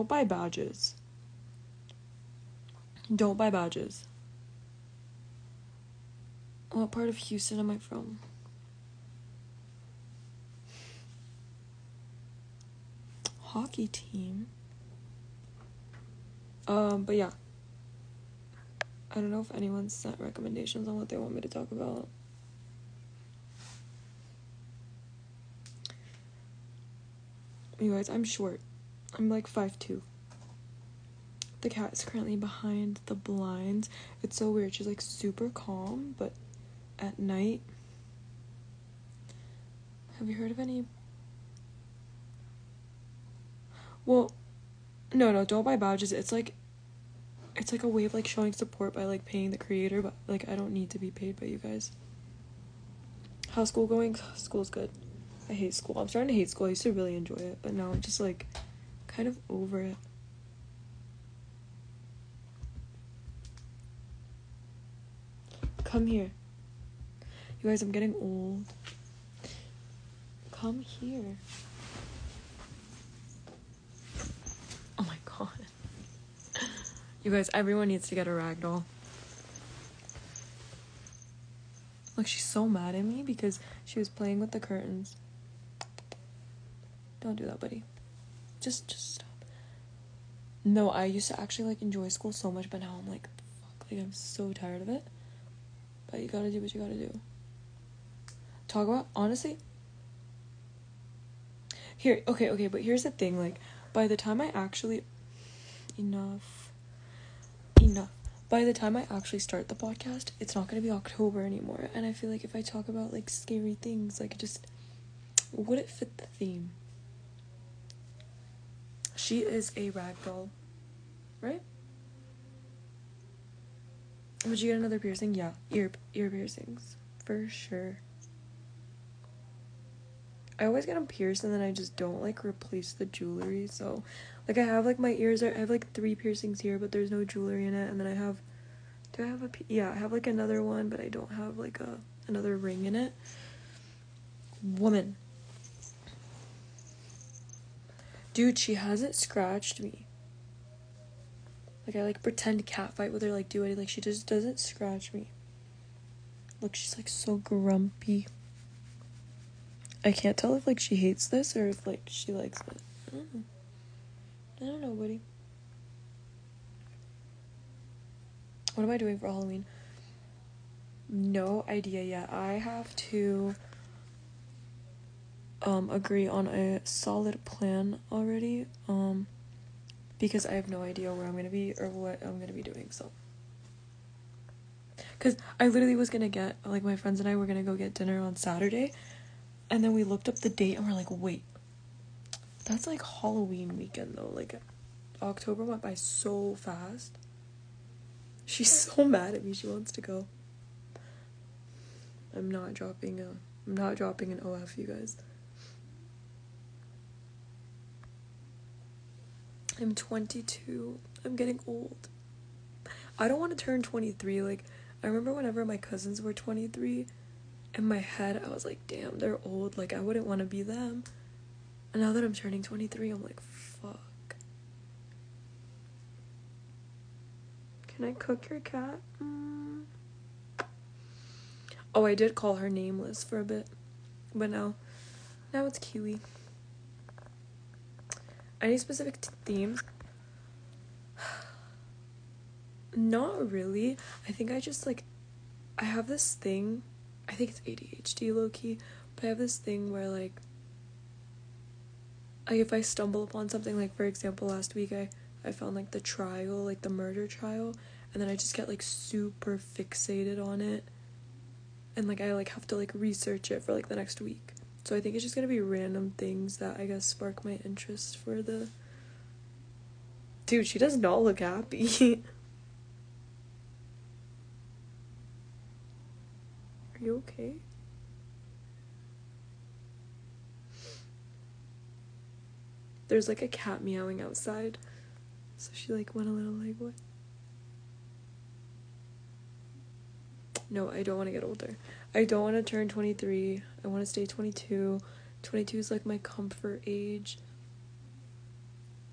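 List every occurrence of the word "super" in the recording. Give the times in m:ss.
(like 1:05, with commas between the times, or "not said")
0:34, 4:18.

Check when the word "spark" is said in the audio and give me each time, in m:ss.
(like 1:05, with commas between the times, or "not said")
4:27.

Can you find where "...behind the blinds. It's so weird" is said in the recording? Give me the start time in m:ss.
0:32.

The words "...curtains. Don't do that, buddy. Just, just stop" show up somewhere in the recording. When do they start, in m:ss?
1:24.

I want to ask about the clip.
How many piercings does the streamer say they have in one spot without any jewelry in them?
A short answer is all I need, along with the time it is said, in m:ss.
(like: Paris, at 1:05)
3, at 2:15.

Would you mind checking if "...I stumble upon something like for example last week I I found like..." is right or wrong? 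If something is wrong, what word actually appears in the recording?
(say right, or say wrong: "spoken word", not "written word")
right.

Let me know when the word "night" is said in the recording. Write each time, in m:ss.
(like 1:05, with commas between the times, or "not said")
0:37.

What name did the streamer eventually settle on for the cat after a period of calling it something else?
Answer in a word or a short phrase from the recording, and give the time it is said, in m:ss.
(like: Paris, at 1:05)
Kiwi, at 3:55.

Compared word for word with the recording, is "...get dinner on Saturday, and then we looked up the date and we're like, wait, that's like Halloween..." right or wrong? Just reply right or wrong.
right.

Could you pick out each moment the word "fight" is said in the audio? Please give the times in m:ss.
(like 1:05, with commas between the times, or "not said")
2:32.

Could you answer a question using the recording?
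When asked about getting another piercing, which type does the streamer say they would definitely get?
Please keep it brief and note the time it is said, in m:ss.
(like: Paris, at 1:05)
Ear piercings, at 2:06.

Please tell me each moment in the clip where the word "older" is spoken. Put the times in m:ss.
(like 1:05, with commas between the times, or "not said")
4:51.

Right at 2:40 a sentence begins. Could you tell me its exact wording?
I can't tell if like she hates this or if like she likes it.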